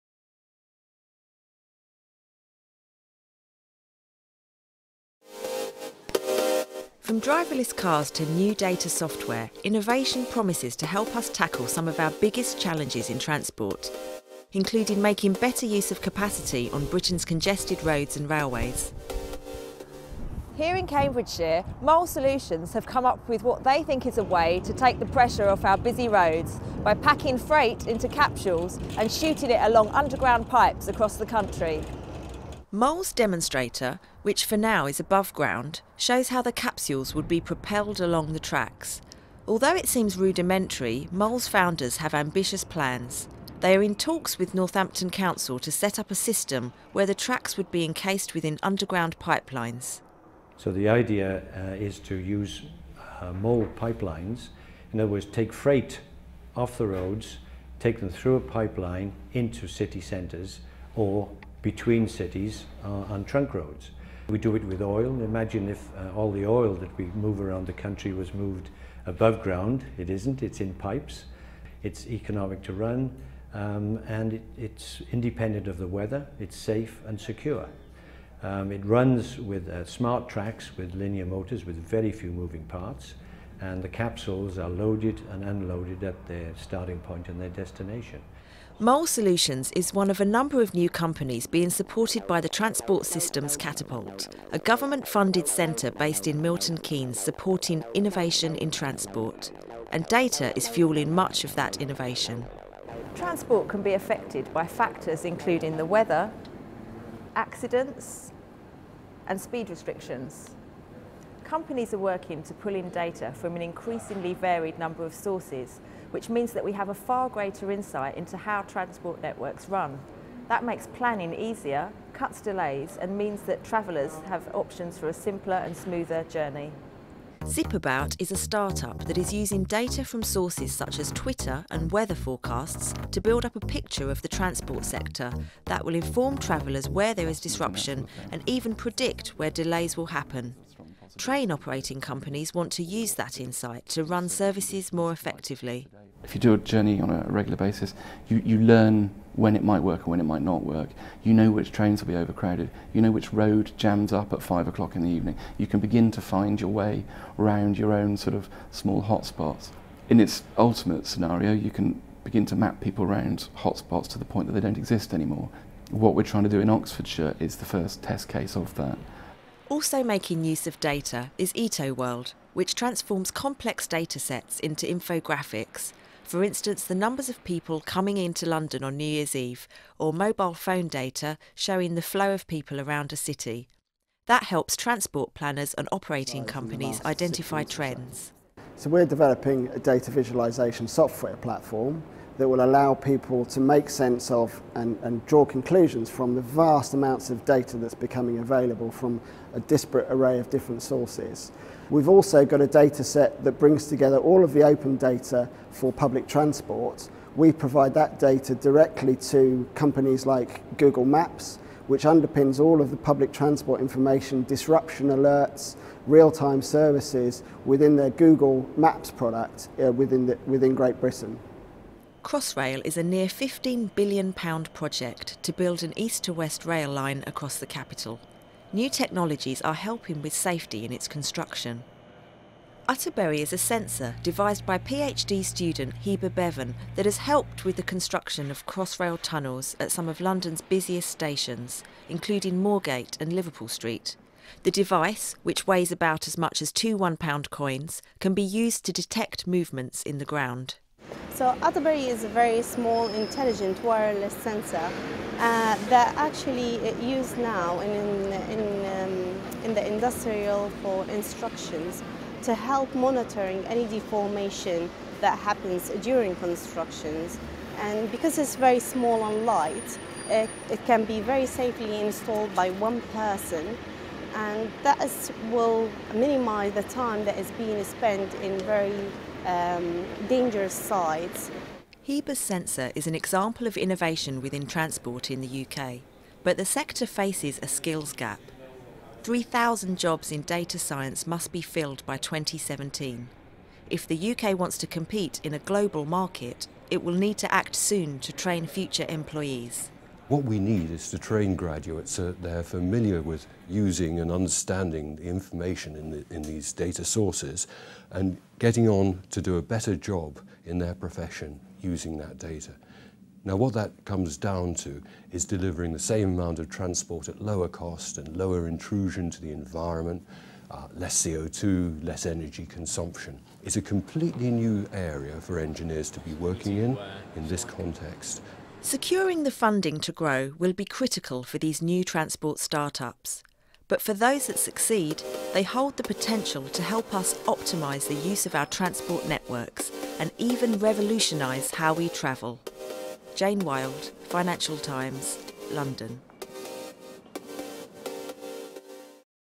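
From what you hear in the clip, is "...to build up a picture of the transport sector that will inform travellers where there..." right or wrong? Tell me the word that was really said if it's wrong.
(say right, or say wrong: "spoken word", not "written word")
right.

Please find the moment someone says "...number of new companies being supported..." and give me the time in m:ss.
1:30.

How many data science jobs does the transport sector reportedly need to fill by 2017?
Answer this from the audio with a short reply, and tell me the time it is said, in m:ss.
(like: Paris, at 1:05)
3,000, at 4:49.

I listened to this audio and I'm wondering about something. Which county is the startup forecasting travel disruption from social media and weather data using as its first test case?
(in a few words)
Oxfordshire.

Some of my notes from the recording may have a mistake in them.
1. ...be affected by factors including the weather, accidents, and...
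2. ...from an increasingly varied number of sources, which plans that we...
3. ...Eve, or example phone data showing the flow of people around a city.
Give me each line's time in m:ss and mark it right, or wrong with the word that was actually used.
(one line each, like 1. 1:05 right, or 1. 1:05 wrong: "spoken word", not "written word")
1. 1:43 right
2. 1:53 wrong: "means", not "plans"
3. 2:59 wrong: "mobile", not "example".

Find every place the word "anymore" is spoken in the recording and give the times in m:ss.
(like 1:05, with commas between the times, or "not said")
2:45.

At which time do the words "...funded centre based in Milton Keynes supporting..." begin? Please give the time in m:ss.
1:35.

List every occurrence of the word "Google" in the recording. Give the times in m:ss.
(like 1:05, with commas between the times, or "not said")
3:30, 3:38.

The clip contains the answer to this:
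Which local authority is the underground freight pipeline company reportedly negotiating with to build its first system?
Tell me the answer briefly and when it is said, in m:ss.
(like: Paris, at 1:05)
Northampton Council, at 0:44.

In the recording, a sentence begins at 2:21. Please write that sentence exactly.
Train operating companies want to use that insight to run services more effectively.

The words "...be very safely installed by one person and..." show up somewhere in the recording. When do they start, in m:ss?
4:31.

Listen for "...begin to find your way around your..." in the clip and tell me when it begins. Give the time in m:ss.
2:35.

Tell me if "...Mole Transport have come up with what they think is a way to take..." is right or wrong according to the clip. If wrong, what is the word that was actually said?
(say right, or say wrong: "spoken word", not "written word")
wrong: "Solutions", not "Transport".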